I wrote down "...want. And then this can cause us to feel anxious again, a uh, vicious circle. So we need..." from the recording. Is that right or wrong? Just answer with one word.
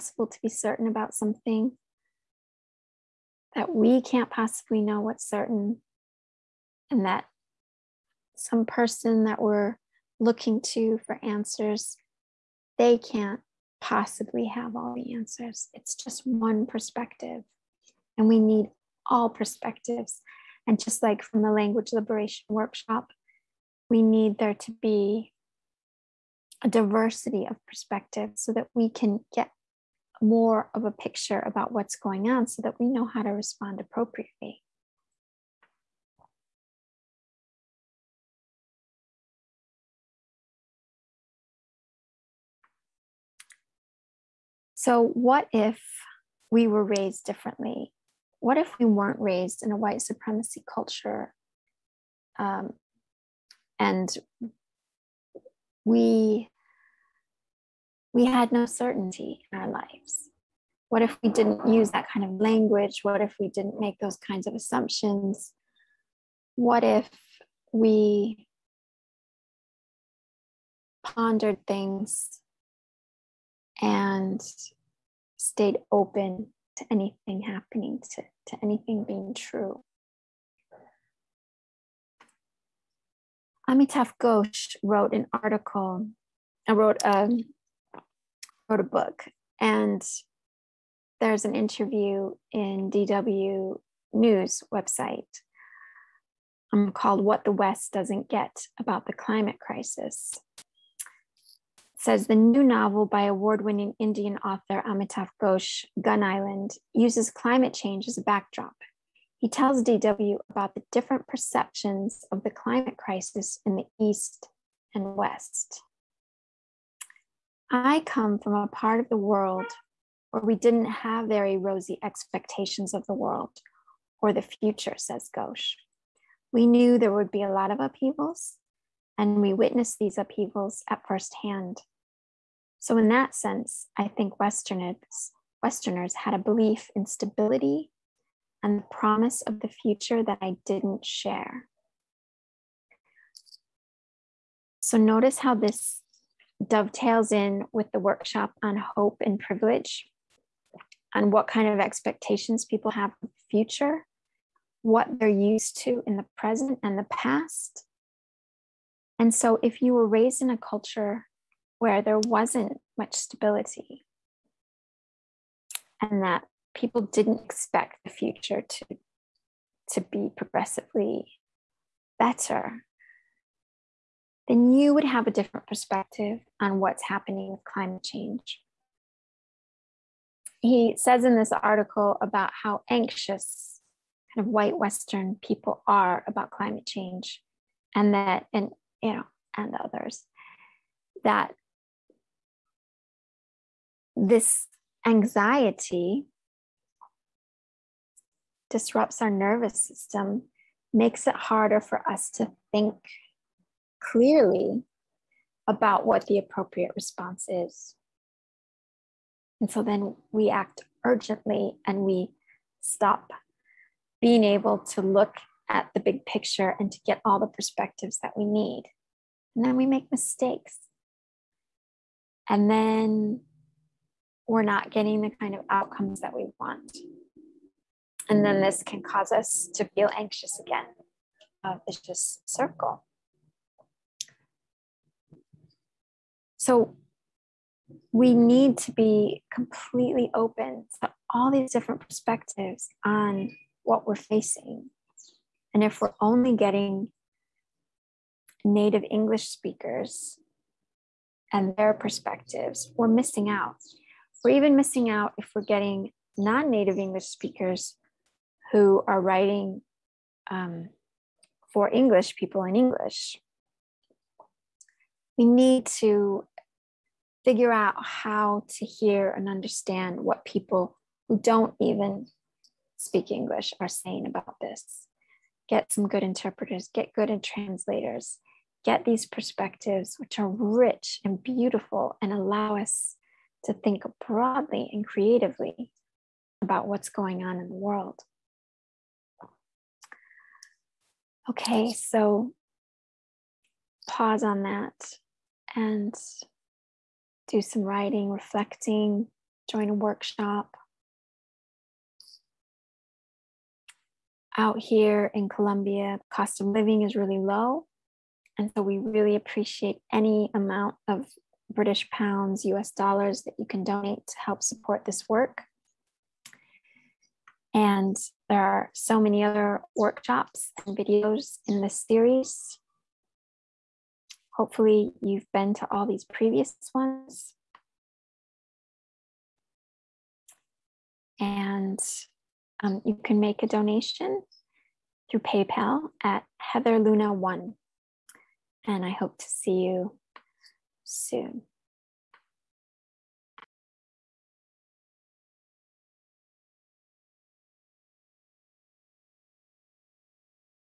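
right.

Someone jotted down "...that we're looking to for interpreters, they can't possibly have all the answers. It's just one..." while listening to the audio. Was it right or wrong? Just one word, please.
wrong.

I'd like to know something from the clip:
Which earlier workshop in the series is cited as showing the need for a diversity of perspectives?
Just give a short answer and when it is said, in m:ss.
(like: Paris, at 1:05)
Language liberation workshop, at 0:21.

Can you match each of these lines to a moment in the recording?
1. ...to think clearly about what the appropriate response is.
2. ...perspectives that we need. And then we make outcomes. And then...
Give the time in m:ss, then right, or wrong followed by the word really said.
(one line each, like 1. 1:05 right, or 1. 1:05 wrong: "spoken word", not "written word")
1. 3:22 right
2. 3:37 wrong: "mistakes", not "outcomes".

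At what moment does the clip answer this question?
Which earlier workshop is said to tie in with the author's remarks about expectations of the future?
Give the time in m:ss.
2:28.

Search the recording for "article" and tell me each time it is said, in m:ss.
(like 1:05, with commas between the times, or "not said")
1:25, 3:01.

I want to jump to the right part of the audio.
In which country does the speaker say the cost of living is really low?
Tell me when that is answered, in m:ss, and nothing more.
5:05.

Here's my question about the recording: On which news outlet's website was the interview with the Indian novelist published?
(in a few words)
DW News.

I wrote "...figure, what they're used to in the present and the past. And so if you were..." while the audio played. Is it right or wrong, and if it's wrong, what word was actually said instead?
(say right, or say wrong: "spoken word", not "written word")
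wrong: "future", not "figure".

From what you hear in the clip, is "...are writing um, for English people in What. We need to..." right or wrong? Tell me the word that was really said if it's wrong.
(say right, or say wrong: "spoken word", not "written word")
wrong: "English", not "What".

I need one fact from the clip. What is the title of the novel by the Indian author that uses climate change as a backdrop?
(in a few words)
Gun Island.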